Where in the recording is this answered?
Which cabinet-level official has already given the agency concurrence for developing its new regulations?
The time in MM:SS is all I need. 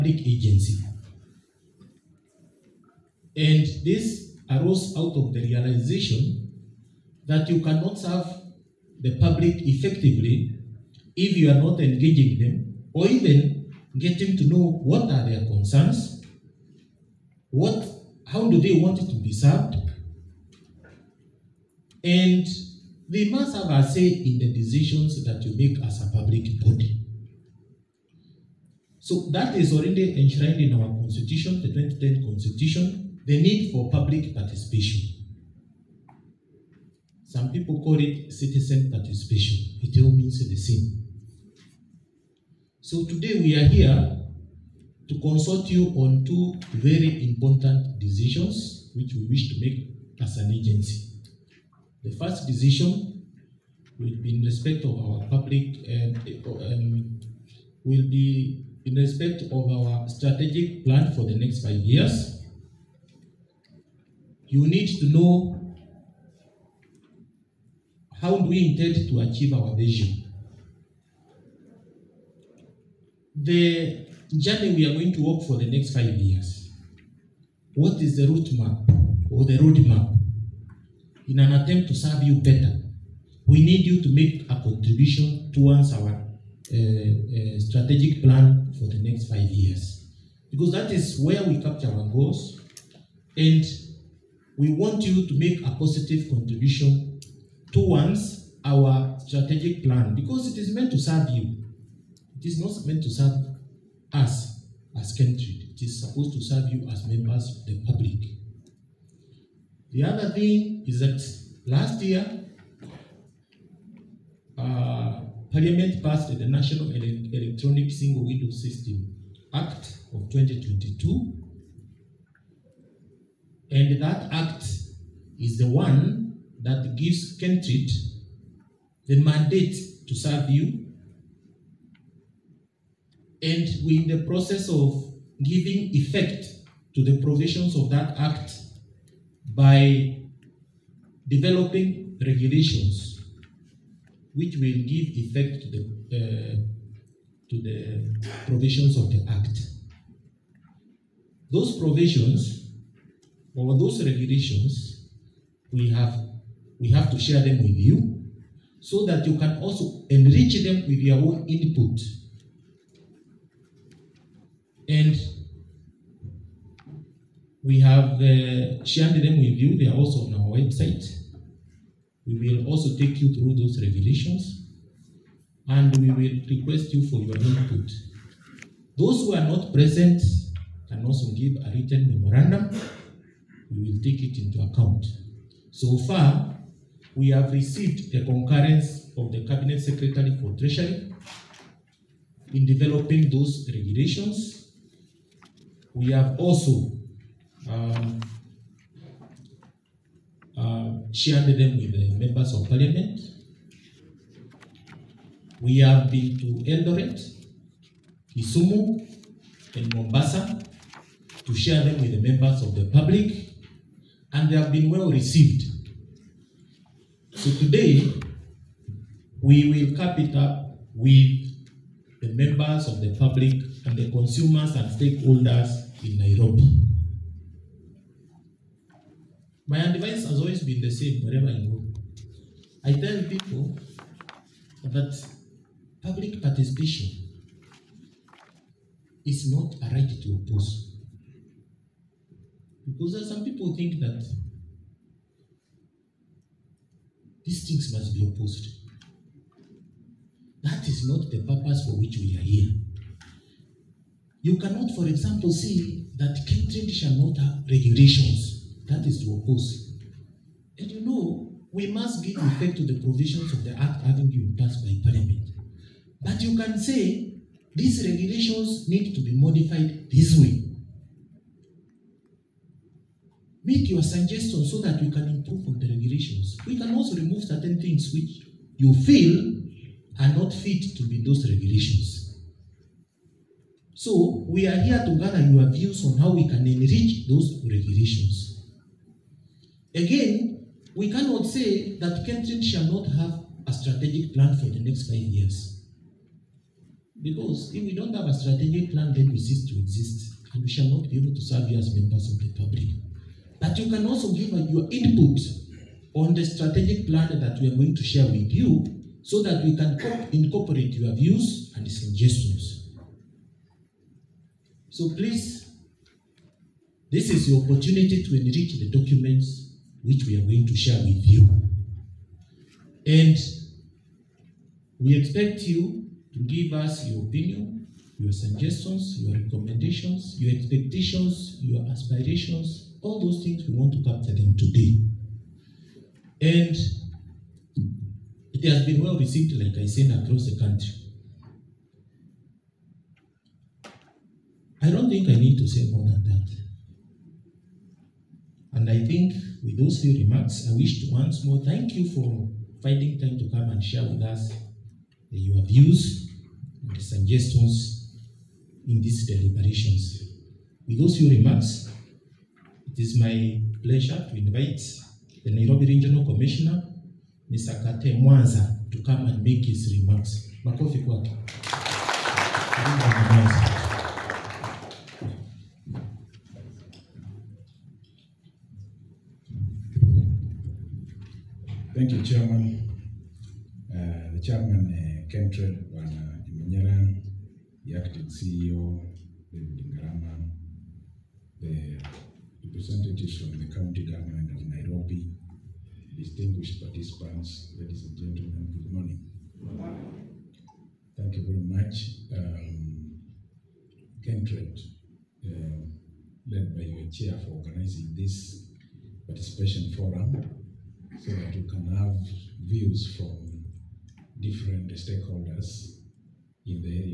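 03:09.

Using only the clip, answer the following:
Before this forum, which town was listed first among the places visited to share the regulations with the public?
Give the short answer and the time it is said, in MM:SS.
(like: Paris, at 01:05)
Eldoret, at 03:26.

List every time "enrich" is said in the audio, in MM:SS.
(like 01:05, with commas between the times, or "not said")
02:40, 04:46, 05:18.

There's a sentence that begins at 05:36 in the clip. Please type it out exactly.
And it has been well received, like I said, across the country.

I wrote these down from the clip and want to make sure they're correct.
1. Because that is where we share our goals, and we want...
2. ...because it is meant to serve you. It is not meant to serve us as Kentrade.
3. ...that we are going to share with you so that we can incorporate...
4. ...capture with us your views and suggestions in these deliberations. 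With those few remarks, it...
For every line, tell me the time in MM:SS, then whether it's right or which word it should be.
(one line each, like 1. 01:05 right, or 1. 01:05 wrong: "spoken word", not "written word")
1. 01:30 wrong: "capture", not "share"
2. 01:40 right
3. 05:07 right
4. 05:53 wrong: "share", not "capture".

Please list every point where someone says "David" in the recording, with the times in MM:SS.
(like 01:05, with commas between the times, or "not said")
06:29.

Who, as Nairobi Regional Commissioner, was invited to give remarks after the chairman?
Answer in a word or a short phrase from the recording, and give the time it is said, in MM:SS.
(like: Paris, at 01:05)
Kate Mwanza, at 06:08.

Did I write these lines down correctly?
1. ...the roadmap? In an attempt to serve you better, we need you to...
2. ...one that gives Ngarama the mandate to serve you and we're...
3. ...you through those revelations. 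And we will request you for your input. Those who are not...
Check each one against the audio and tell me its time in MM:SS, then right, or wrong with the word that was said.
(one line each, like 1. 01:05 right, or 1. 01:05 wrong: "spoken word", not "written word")
1. 01:19 right
2. 02:05 wrong: "Kentrade", not "Ngarama"
3. 02:53 right.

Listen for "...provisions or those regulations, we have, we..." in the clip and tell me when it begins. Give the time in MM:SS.
02:31.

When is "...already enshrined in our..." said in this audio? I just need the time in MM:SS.
00:29.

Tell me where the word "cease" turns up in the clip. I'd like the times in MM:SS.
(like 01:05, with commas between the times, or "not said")
04:59.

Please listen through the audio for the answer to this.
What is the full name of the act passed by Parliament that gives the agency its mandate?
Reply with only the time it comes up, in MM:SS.
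01:56.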